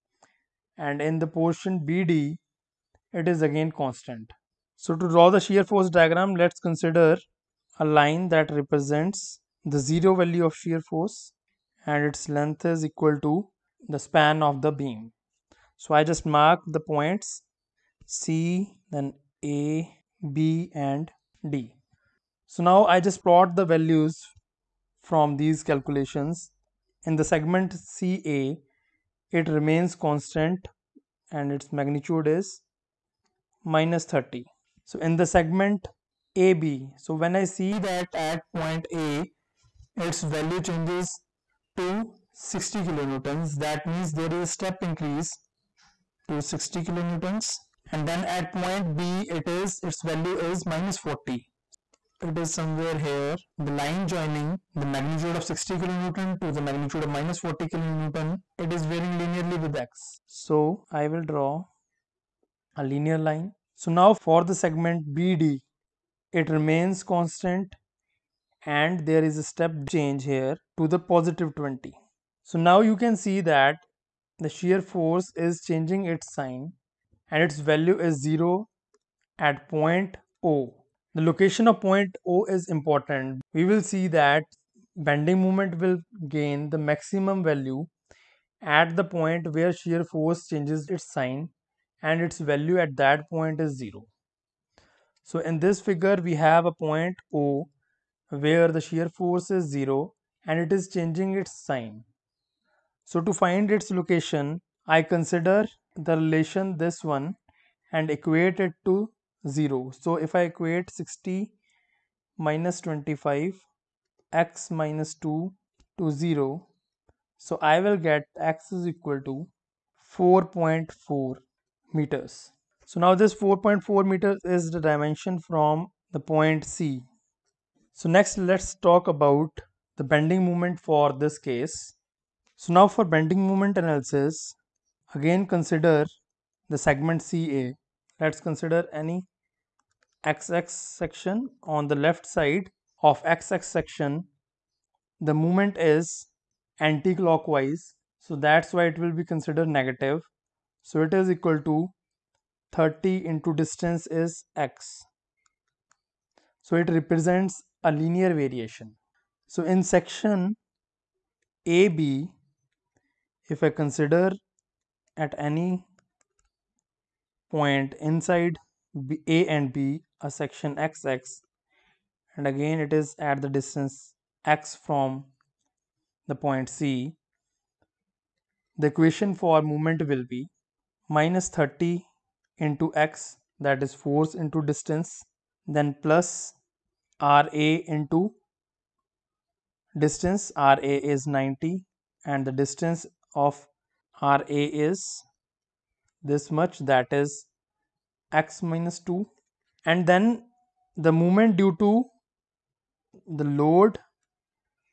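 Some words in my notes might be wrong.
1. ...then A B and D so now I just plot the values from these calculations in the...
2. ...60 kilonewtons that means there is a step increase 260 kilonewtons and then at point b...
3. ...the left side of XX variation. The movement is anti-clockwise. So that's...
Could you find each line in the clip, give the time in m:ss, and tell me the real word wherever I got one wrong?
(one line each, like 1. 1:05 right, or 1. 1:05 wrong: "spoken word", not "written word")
1. 0:18 right
2. 0:42 right
3. 2:21 wrong: "section", not "variation".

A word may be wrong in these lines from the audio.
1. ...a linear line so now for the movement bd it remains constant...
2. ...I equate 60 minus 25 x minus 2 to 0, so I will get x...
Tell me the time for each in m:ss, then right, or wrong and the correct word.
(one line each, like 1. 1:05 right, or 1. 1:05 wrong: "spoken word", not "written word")
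1. 1:02 wrong: "segment", not "movement"
2. 1:50 right.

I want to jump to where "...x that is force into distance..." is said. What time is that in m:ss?
3:02.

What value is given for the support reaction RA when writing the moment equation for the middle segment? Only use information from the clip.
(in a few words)
90.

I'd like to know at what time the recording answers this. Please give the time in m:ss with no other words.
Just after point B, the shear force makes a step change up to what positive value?
1:11.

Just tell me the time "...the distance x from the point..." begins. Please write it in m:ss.
2:53.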